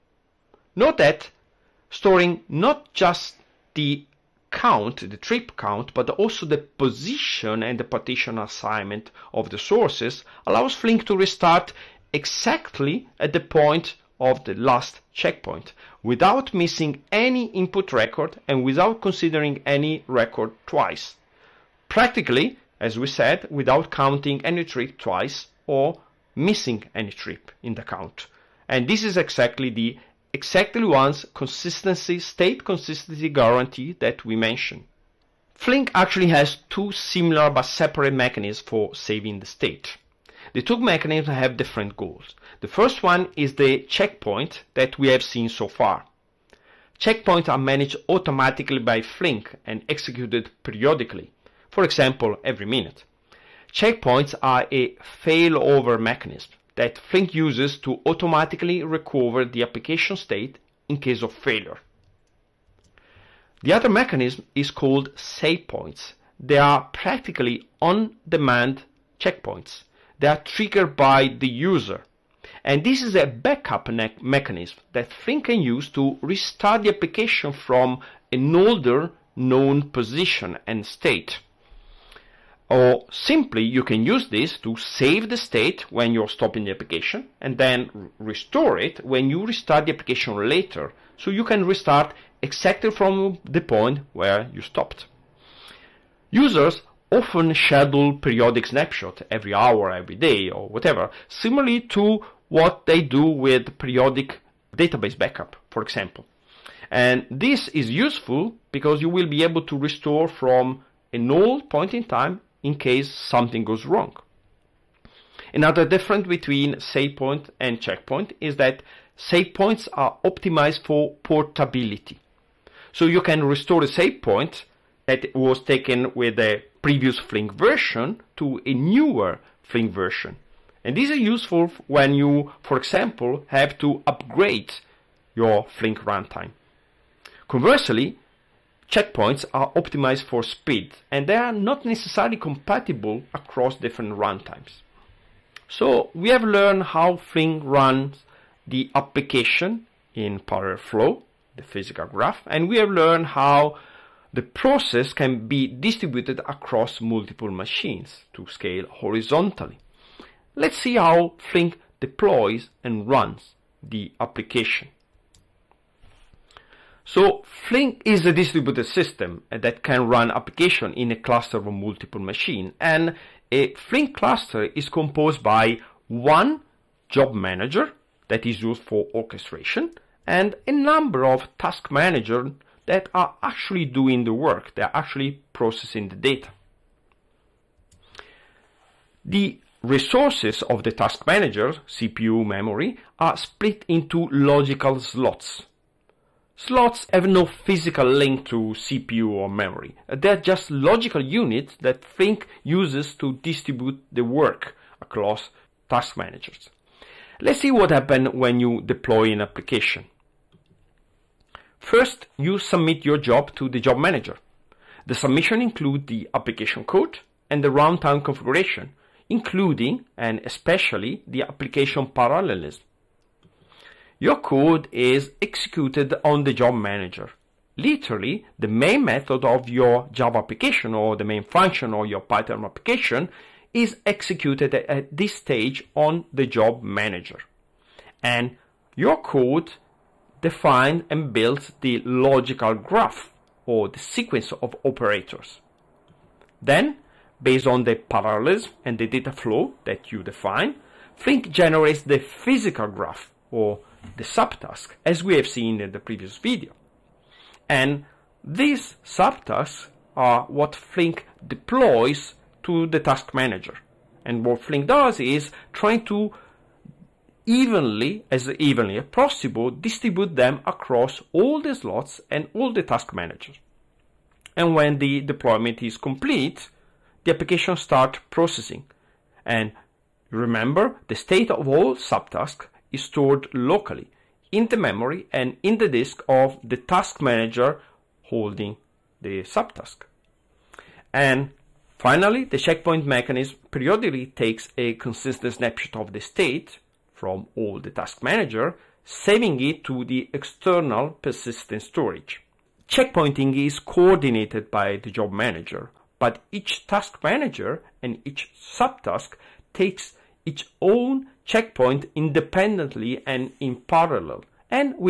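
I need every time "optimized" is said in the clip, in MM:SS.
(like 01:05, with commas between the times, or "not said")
02:00, 02:19.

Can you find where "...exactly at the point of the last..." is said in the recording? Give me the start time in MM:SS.
00:12.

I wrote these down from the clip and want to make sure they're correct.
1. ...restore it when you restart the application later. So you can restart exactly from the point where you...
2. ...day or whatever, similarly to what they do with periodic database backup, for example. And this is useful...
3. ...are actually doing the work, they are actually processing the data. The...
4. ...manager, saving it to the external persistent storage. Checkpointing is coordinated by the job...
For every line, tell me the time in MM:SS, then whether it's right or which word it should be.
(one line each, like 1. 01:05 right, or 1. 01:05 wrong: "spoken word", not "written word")
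1. 01:28 right
2. 01:40 right
3. 03:03 right
4. 04:58 right.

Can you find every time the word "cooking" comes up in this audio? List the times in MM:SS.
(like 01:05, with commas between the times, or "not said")
not said.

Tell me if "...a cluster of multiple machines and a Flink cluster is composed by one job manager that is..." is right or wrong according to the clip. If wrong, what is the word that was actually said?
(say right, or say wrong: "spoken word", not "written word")
right.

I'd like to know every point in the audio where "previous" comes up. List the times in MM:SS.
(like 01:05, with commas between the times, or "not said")
02:06, 04:15.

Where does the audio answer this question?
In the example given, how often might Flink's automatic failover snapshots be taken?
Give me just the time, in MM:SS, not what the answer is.
00:52.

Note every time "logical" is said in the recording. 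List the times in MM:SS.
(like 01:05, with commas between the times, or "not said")
03:14, 03:20, 04:02.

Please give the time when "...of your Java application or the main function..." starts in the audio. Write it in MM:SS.
03:49.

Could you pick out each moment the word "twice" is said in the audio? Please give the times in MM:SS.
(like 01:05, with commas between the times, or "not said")
00:20, 00:24.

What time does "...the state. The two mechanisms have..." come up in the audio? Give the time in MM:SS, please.
00:39.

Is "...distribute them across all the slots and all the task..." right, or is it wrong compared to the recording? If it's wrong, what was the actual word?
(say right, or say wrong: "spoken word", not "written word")
right.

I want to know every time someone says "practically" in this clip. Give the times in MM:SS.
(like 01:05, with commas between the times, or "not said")
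00:21, 01:06.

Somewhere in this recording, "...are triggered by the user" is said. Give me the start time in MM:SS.
01:10.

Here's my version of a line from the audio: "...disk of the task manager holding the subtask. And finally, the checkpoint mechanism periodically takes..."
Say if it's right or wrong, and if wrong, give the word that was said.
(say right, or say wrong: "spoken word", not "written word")
right.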